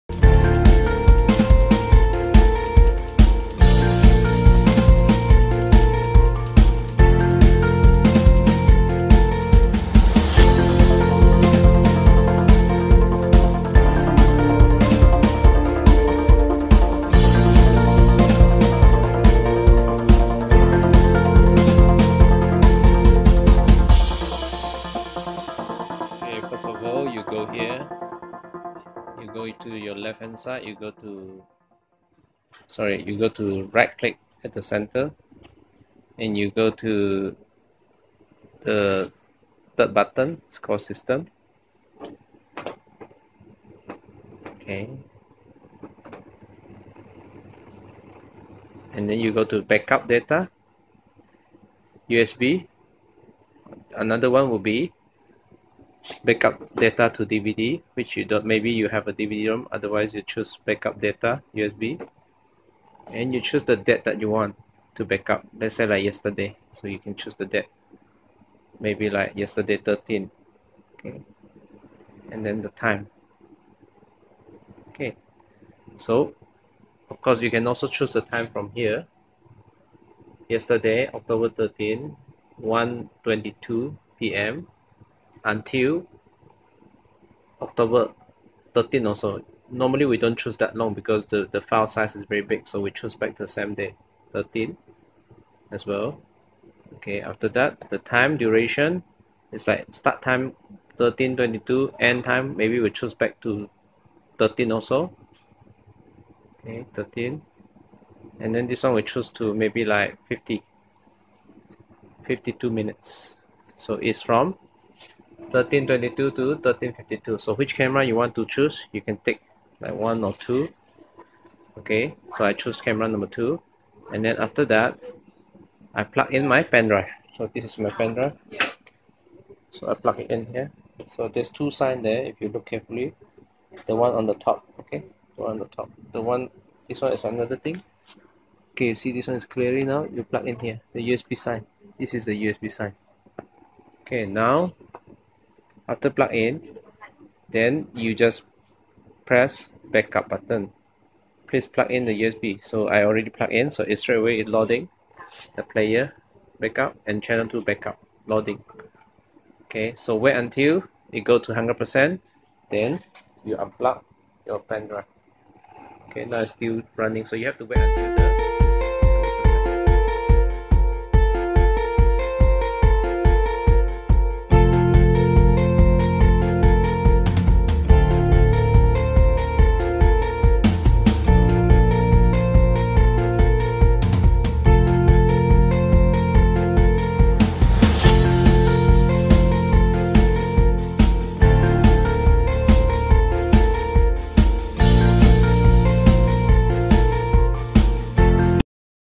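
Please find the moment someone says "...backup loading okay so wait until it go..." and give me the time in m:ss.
2:37.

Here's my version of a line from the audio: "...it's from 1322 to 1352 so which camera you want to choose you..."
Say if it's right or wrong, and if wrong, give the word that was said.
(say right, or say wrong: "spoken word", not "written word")
right.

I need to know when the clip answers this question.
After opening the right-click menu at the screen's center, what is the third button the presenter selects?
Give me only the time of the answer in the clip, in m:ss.
0:40.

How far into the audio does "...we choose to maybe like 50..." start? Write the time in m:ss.
1:48.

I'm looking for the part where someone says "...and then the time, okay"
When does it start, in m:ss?
1:12.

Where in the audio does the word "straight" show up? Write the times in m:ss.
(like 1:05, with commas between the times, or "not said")
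2:34.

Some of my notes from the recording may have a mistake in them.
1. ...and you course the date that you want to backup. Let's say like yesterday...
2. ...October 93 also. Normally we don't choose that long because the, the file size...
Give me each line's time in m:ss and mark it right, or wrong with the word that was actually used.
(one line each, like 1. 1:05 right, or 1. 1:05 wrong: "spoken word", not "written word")
1. 1:03 wrong: "choose", not "course"
2. 1:27 wrong: "13", not "93".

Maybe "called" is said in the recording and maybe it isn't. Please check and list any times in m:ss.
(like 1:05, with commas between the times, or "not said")
0:40.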